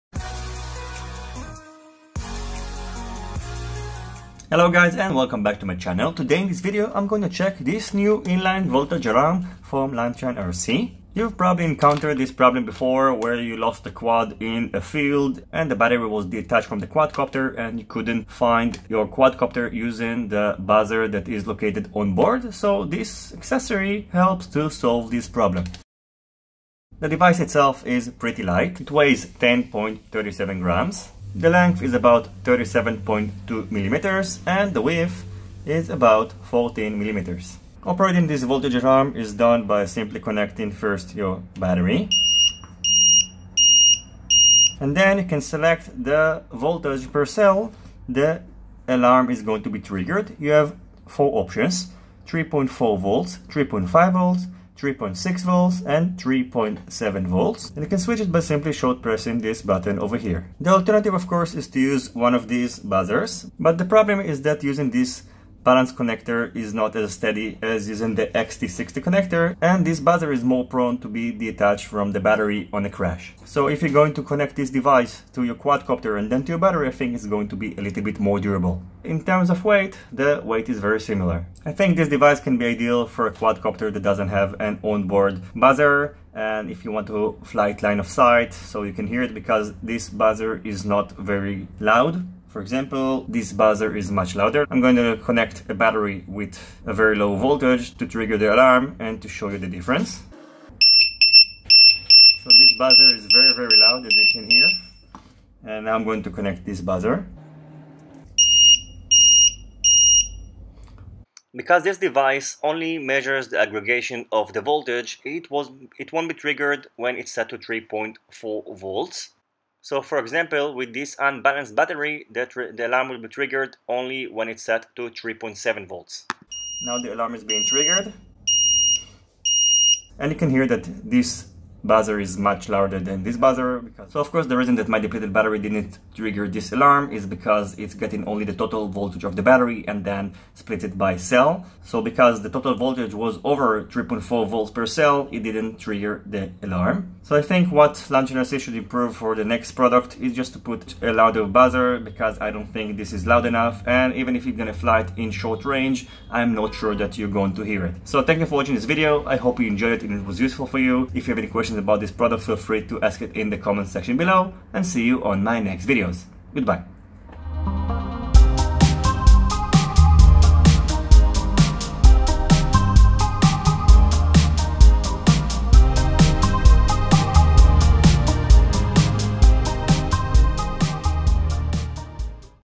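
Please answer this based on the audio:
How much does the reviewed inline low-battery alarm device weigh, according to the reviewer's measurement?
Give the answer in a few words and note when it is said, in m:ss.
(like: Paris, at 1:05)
10.37 grams, at 0:29.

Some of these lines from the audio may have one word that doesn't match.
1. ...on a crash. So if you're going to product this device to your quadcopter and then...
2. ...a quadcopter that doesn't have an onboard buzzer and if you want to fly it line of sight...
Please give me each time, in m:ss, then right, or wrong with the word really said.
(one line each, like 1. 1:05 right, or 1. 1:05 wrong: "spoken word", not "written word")
1. 1:12 wrong: "connect", not "product"
2. 1:23 right.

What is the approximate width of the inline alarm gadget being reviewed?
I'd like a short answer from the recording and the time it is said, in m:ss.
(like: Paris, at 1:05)
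14 millimeters, at 0:36.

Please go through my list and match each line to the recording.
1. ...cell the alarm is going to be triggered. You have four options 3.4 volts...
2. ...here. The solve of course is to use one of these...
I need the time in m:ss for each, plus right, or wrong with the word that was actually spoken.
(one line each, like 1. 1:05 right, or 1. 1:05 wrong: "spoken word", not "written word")
1. 0:47 right
2. 1:00 wrong: "alternative", not "solve".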